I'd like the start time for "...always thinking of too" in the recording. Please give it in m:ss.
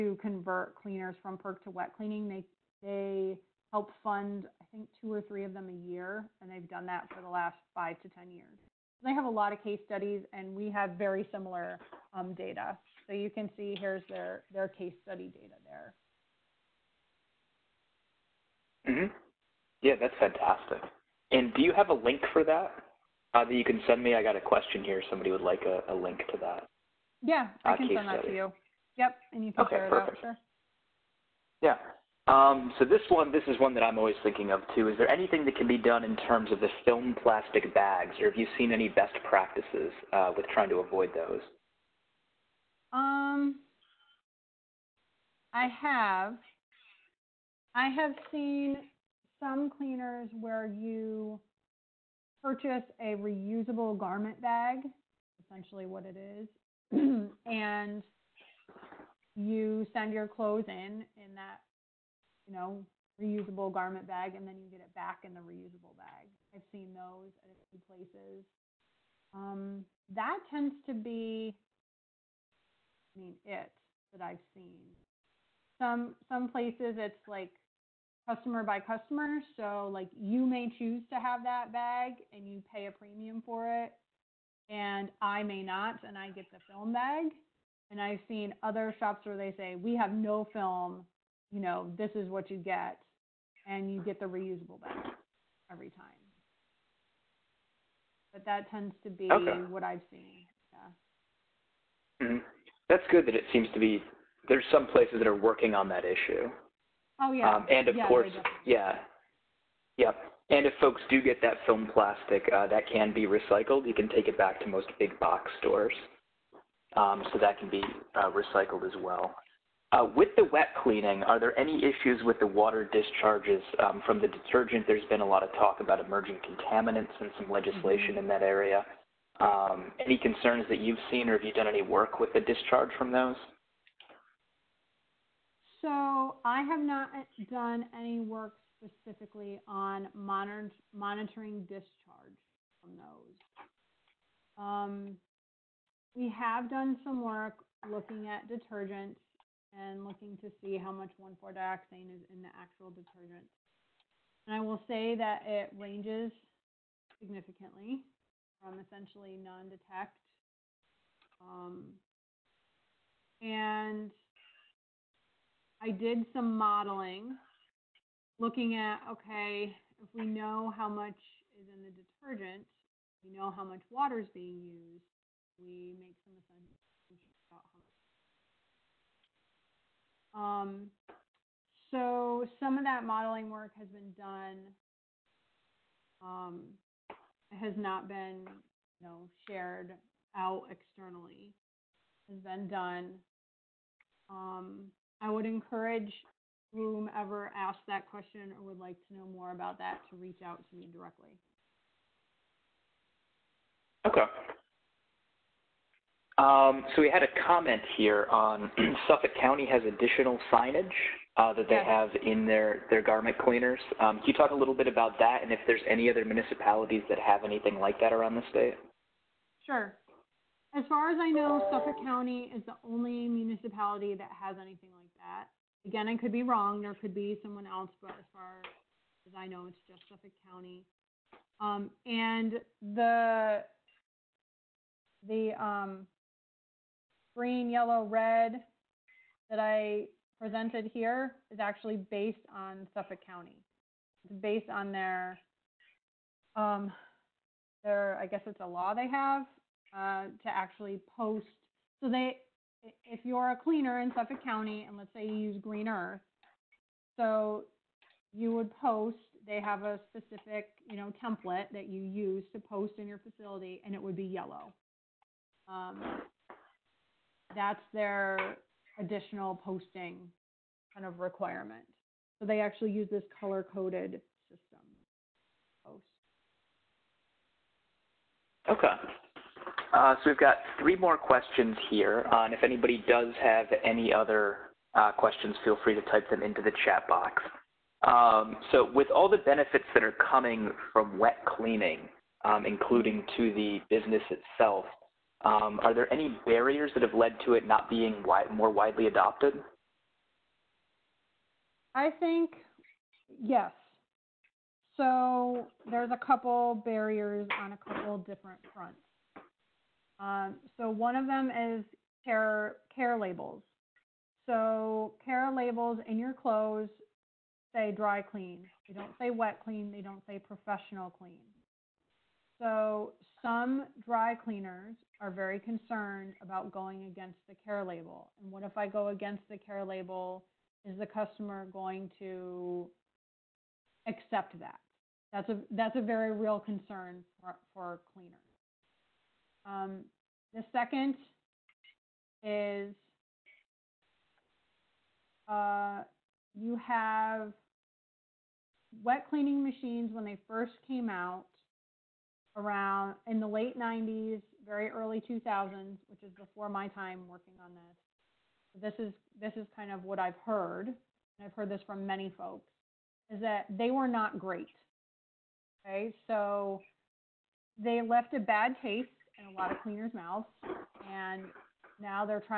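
0:33.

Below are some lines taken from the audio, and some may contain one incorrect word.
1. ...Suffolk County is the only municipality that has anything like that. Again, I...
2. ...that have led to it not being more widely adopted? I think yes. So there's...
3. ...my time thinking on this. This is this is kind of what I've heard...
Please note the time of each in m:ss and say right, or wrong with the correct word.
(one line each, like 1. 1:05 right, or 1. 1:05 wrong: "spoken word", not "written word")
1. 3:41 right
2. 4:56 right
3. 5:56 wrong: "working", not "thinking".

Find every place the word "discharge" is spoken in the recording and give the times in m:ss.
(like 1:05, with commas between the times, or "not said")
2:02, 2:12, 2:21.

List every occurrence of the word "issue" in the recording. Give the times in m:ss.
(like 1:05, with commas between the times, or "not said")
1:46, 2:01.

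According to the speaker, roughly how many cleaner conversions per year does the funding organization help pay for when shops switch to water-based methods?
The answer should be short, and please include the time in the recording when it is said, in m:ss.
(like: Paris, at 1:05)
2 or 3, at 0:04.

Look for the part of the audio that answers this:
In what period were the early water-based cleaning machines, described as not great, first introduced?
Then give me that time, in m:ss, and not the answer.
5:53.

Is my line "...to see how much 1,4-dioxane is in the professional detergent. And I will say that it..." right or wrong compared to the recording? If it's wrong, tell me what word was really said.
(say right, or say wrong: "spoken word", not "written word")
wrong: "actual", not "professional".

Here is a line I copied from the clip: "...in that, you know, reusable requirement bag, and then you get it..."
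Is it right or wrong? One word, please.
wrong.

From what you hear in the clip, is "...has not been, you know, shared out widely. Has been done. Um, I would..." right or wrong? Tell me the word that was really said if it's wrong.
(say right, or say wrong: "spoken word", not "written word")
wrong: "externally", not "widely".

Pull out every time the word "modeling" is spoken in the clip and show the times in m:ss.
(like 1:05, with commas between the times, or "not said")
2:46, 3:03.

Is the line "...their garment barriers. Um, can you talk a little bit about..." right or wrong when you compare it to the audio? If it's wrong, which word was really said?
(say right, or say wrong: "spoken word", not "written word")
wrong: "cleaners", not "barriers".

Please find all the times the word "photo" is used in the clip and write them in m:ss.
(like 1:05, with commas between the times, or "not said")
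not said.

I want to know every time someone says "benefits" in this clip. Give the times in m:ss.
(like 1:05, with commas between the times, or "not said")
4:49.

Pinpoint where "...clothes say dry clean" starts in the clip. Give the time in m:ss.
5:16.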